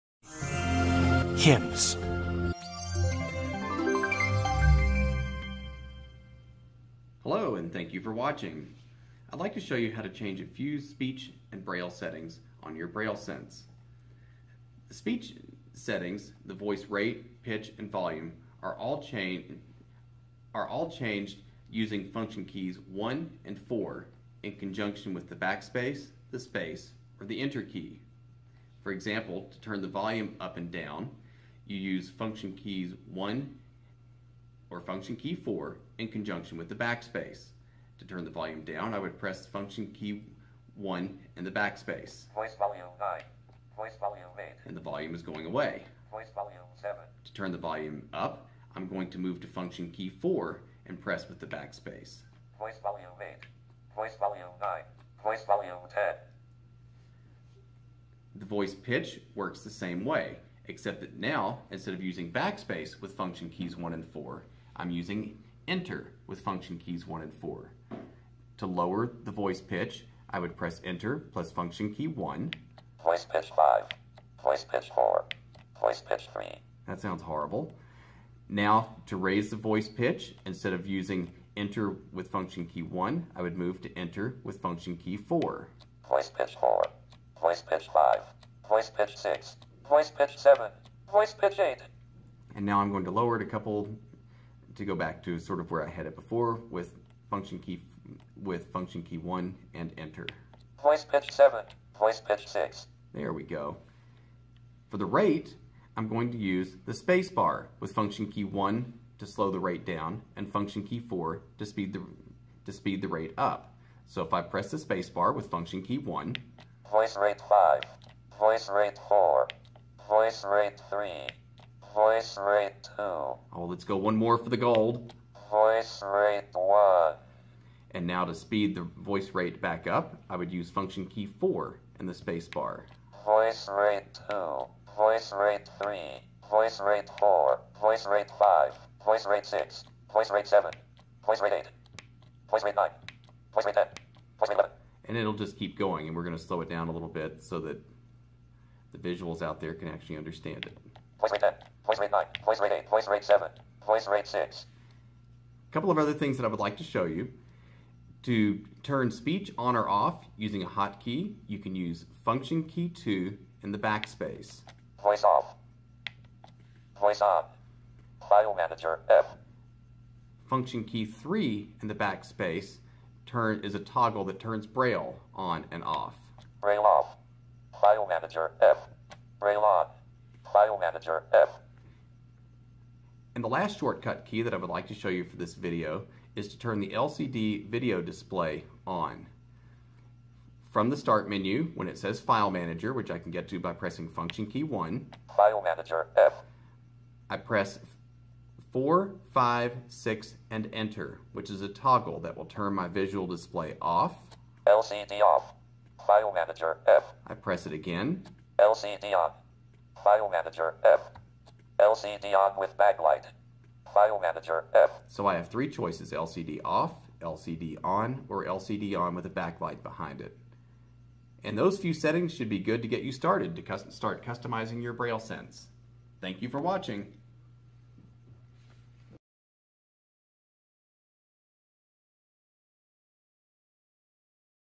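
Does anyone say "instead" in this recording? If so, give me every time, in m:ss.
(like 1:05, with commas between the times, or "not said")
1:01, 1:20.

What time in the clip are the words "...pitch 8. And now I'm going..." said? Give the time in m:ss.
1:31.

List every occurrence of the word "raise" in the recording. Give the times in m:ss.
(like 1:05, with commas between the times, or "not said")
1:19.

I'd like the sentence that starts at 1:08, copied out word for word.
To lower the voice pitch, I would press enter plus function key 1.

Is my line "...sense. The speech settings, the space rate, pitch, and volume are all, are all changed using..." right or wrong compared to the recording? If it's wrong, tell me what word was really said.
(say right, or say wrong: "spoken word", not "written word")
wrong: "voice", not "space".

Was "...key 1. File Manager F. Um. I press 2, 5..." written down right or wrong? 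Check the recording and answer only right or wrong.
wrong.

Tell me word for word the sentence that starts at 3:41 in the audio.
And those few settings should be good to get you started to start customizing your Braille Sense.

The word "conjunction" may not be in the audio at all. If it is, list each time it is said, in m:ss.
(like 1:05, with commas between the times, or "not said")
0:24, 0:36.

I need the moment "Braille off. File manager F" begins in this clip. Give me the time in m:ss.
2:56.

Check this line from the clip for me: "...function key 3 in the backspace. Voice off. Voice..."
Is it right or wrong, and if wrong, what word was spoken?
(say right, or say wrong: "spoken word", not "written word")
wrong: "2", not "3".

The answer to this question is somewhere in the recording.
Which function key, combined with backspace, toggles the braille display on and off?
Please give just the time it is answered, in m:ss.
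2:50.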